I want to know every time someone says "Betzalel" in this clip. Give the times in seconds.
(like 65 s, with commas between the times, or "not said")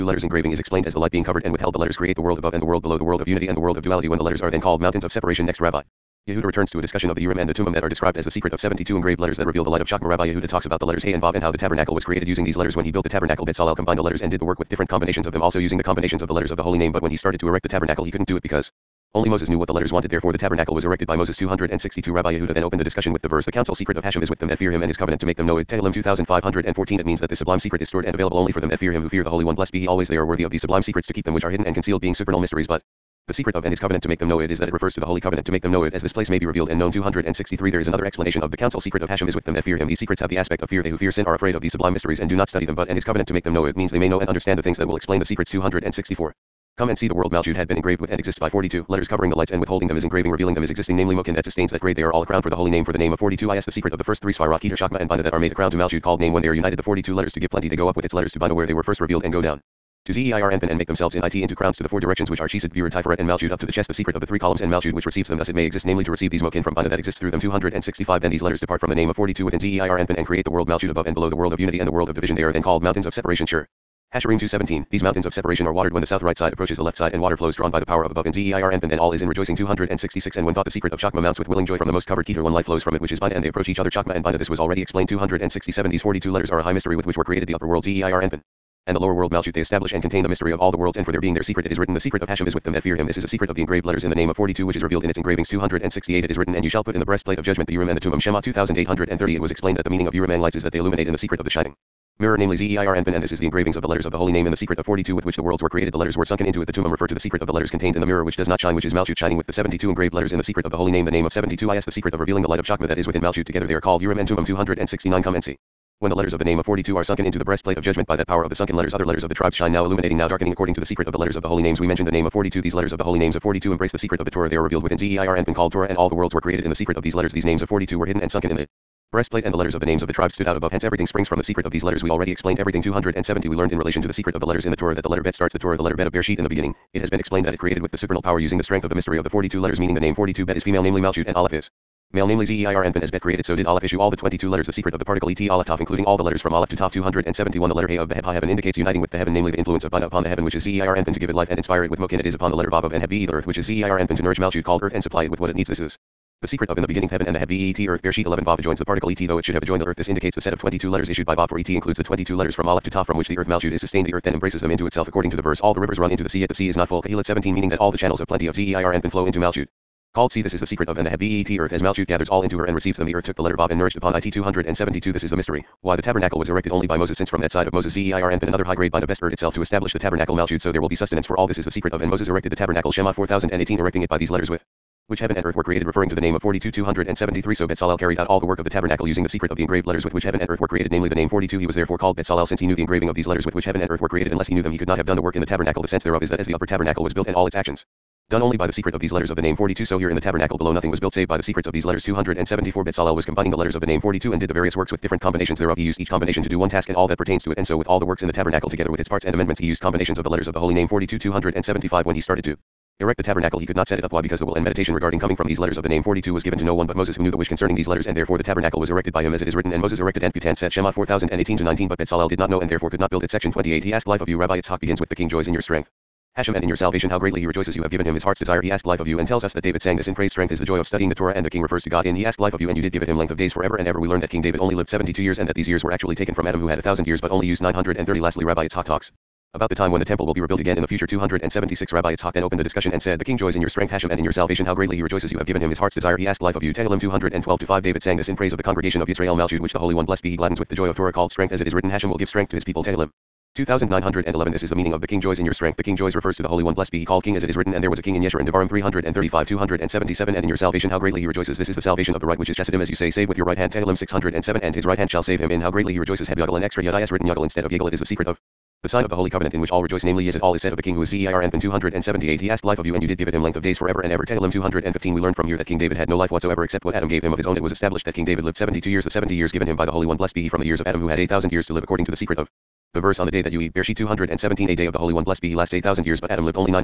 13 s, 187 s, 192 s, 202 s, 221 s.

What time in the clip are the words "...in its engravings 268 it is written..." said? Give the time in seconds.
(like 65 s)
95 s.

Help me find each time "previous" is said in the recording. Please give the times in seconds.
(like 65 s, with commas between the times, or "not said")
not said.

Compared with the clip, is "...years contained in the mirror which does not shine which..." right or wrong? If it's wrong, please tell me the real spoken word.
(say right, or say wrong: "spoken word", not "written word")
wrong: "letters", not "years".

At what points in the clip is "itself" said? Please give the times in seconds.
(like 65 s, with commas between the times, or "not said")
164 s, 179 s.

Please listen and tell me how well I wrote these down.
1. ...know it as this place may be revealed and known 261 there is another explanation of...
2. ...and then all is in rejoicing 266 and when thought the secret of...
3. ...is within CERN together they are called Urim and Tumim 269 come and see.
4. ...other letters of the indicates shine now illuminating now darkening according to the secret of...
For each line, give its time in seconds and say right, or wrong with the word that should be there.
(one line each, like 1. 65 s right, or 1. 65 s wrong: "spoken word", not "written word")
1. 35 s wrong: "263", not "261"
2. 78 s right
3. 112 s wrong: "Malchut", not "CERN"
4. 118 s wrong: "tribes", not "indicates".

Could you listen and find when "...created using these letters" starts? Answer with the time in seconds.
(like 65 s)
12 s.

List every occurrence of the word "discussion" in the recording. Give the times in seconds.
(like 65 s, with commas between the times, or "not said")
6 s, 22 s, 242 s.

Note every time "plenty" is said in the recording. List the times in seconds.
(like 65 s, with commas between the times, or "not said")
57 s, 168 s.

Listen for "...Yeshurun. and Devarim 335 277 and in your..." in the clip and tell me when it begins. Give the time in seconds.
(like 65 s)
258 s.